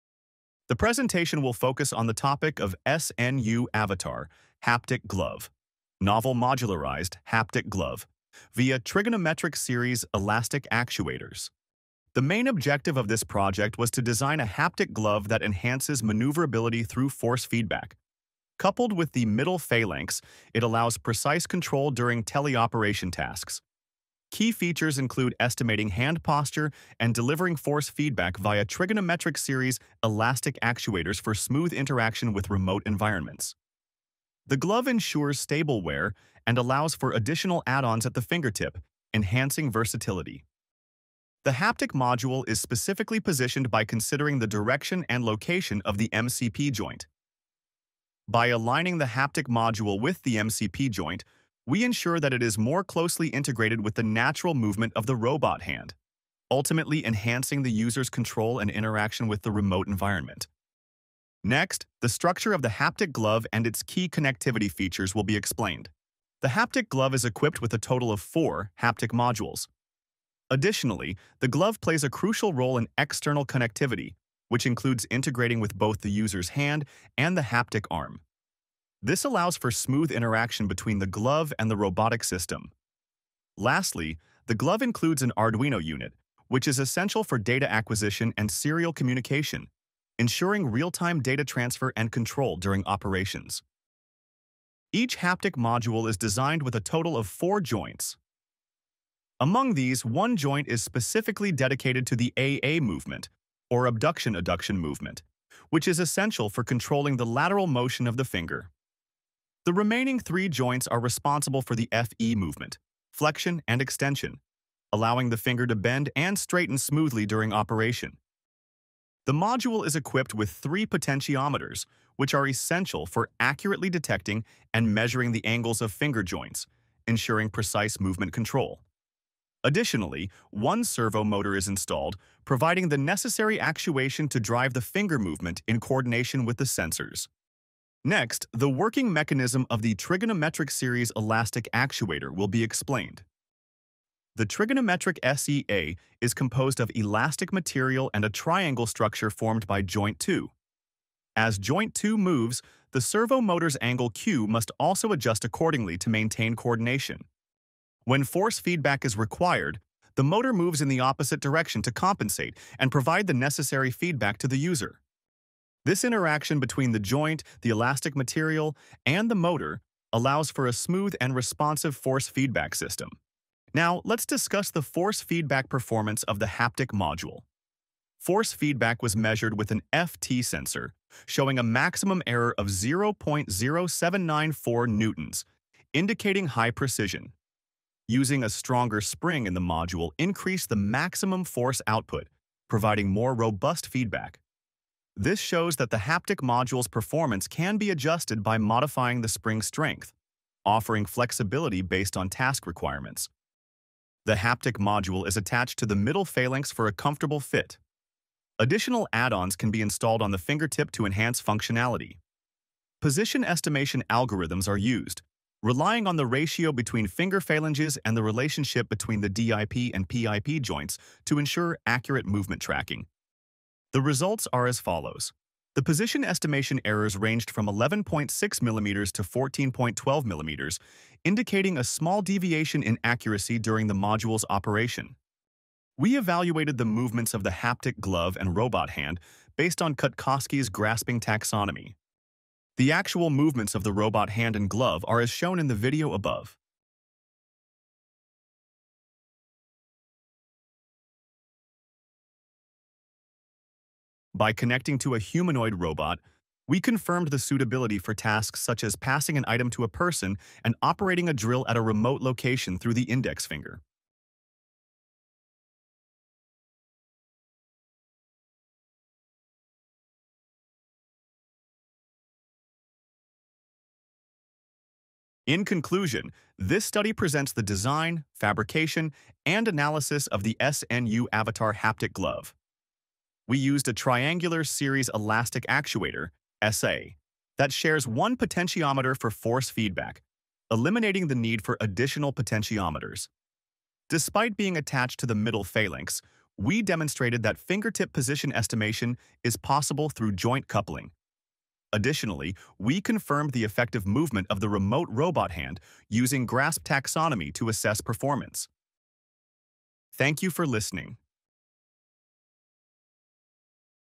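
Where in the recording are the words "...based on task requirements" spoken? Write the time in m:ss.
3:21.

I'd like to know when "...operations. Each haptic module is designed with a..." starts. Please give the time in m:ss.
1:32.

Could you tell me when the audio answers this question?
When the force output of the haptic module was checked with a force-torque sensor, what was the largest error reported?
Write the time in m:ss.
3:02.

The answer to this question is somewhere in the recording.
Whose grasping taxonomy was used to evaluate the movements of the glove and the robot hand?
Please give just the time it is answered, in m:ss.
3:59.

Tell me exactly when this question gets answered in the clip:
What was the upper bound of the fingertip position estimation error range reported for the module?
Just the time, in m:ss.
3:49.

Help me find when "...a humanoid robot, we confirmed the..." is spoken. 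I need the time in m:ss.
4:15.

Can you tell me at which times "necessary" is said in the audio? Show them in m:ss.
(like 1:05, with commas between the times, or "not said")
2:12, 2:43.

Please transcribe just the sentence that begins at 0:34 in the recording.
The glove ensures stable wear and allows for additional add-ons at the fingertip, enhancing versatility.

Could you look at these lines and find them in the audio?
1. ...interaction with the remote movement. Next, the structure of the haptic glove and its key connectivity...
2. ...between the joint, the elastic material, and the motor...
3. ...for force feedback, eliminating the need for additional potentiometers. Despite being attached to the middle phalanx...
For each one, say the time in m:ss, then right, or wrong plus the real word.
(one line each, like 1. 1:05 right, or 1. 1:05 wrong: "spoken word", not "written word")
1. 0:58 wrong: "environment", not "movement"
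2. 2:46 right
3. 4:49 right.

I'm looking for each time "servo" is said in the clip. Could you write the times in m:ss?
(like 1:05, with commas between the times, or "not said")
2:10, 2:33.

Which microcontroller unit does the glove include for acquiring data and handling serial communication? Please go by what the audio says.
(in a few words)
Arduino.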